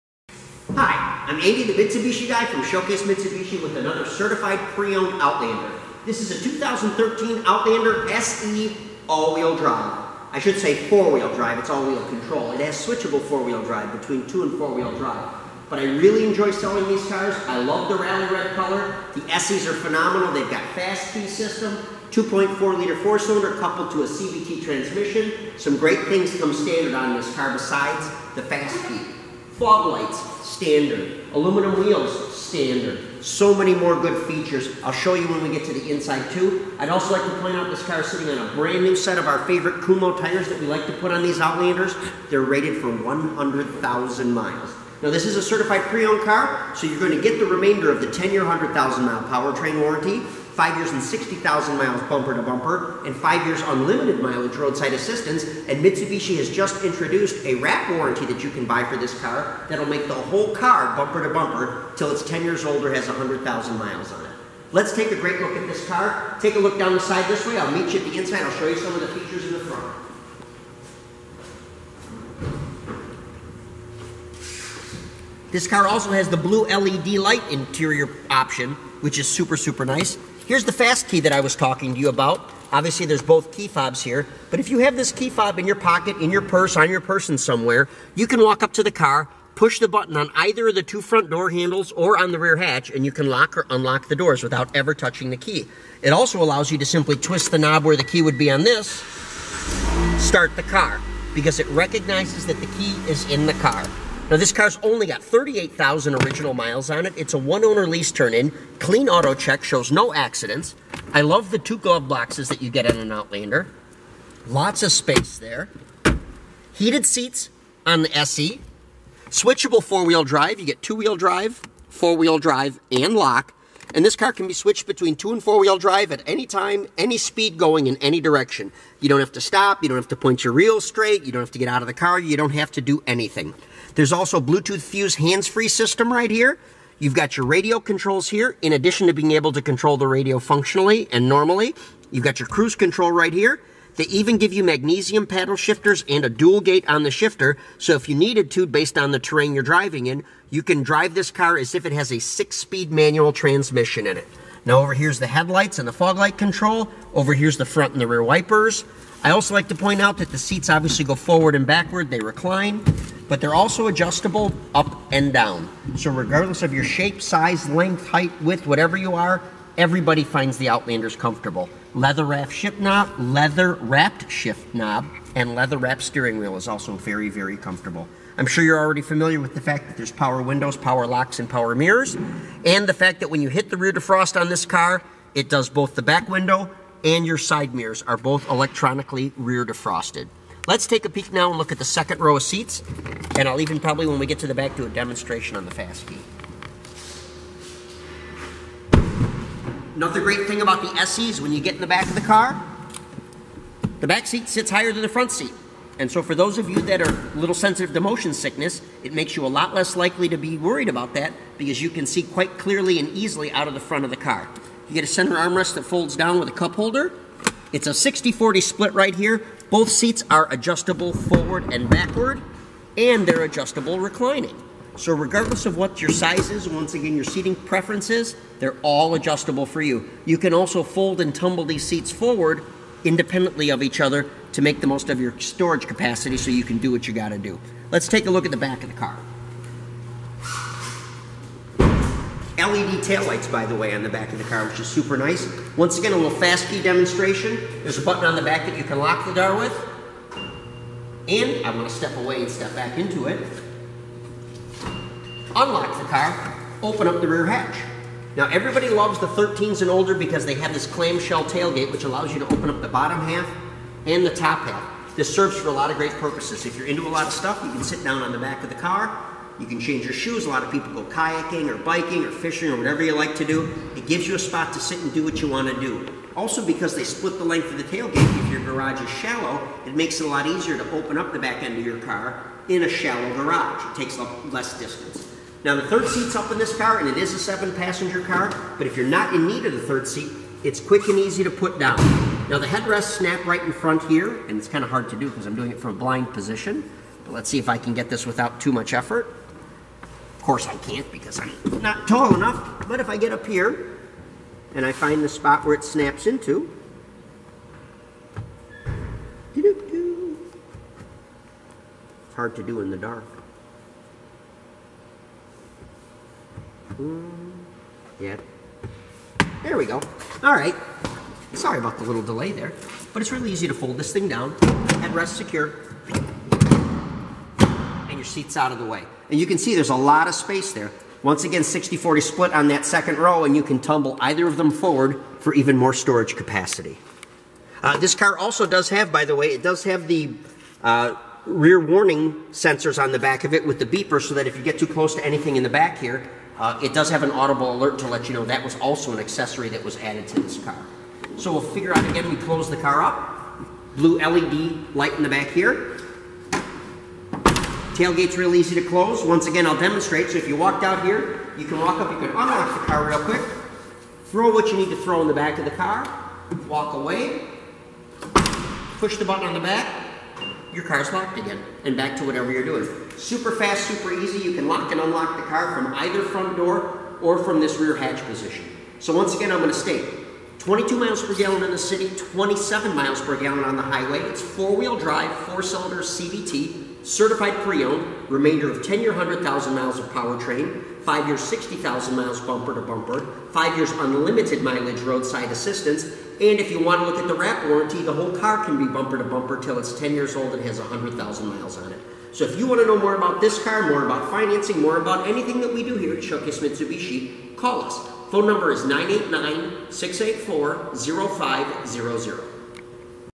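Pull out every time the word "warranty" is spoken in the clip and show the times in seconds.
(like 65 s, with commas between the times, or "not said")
49 s, 57 s, 397 s.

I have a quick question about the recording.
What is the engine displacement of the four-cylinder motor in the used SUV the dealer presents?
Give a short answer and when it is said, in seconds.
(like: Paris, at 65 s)
2.4 liter, at 22 s.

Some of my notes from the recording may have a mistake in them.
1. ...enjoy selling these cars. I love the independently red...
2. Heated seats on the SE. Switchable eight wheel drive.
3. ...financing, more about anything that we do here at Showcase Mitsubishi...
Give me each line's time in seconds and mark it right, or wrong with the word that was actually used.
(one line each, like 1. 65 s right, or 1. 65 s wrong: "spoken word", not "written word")
1. 16 s wrong: "rally", not "independently"
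2. 116 s wrong: "four", not "eight"
3. 404 s right.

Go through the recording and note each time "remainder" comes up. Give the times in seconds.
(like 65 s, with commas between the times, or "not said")
47 s, 388 s.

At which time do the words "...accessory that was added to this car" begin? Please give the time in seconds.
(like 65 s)
349 s.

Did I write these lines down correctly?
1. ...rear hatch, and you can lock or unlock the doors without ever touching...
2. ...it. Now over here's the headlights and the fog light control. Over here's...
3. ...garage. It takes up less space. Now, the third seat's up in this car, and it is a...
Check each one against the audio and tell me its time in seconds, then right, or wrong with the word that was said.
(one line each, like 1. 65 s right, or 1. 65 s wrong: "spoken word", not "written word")
1. 92 s right
2. 154 s right
3. 283 s wrong: "distance", not "space".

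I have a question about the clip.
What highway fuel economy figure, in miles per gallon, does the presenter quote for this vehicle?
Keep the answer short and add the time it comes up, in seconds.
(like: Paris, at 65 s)
27, at 382 s.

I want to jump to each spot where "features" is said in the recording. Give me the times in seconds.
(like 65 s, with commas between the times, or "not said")
34 s, 69 s.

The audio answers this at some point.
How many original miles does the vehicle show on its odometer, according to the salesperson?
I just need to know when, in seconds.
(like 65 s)
105 s.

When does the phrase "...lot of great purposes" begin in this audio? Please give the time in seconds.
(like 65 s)
265 s.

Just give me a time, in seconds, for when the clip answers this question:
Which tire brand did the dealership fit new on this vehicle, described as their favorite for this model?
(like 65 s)
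39 s.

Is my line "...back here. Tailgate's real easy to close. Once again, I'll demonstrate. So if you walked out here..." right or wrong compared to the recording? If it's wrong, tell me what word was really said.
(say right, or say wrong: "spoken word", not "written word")
right.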